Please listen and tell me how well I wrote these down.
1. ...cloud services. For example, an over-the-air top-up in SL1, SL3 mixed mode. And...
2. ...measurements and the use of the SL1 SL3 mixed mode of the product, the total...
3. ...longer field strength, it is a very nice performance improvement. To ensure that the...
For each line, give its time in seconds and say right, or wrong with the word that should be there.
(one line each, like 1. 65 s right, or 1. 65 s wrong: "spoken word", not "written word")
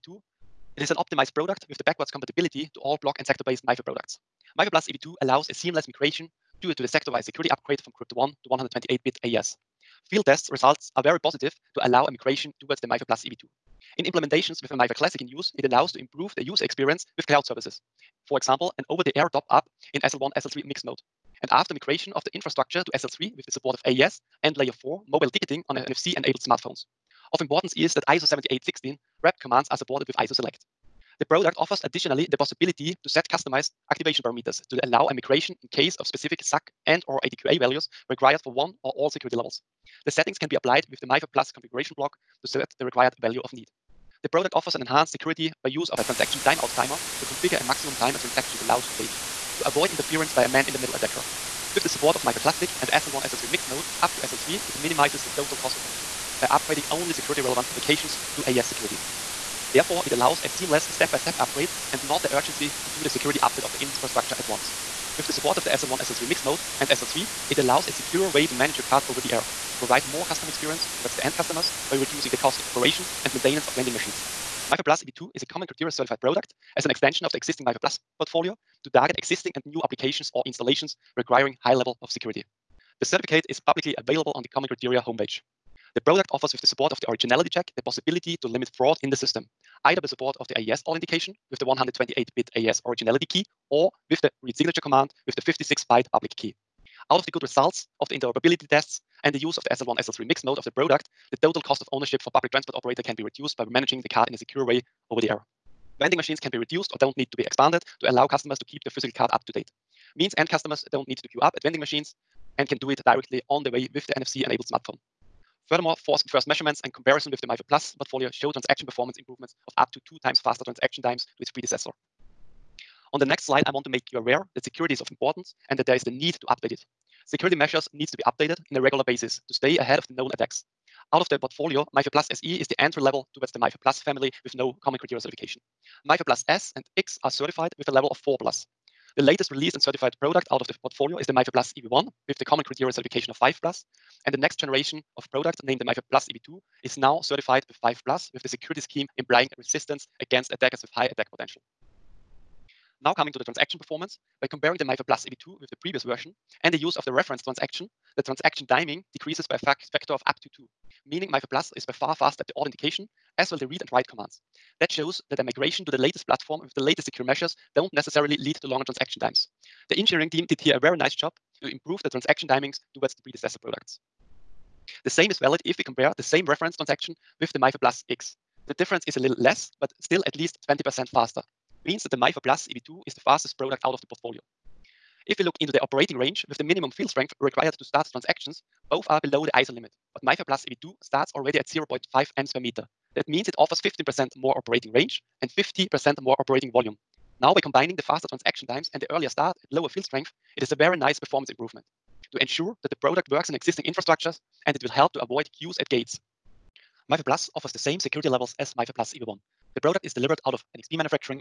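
1. 17 s right
2. 98 s wrong: "tests", not "measurements"
3. 199 s wrong: "lower", not "longer".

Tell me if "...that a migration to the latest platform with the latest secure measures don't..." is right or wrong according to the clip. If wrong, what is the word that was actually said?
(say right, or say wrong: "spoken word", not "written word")
right.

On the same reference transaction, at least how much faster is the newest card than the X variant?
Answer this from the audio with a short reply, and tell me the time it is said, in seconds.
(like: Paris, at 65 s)
20%, at 180 s.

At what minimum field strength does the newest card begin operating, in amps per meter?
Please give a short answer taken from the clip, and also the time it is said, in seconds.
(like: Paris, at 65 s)
0.5, at 191 s.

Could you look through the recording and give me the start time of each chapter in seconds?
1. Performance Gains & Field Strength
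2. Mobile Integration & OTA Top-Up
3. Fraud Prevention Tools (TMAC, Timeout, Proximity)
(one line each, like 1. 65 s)
1. 68 s
2. 132 s
3. 197 s.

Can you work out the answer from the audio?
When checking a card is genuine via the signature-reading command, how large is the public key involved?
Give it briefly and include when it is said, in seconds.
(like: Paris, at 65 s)
56-byte, at 95 s.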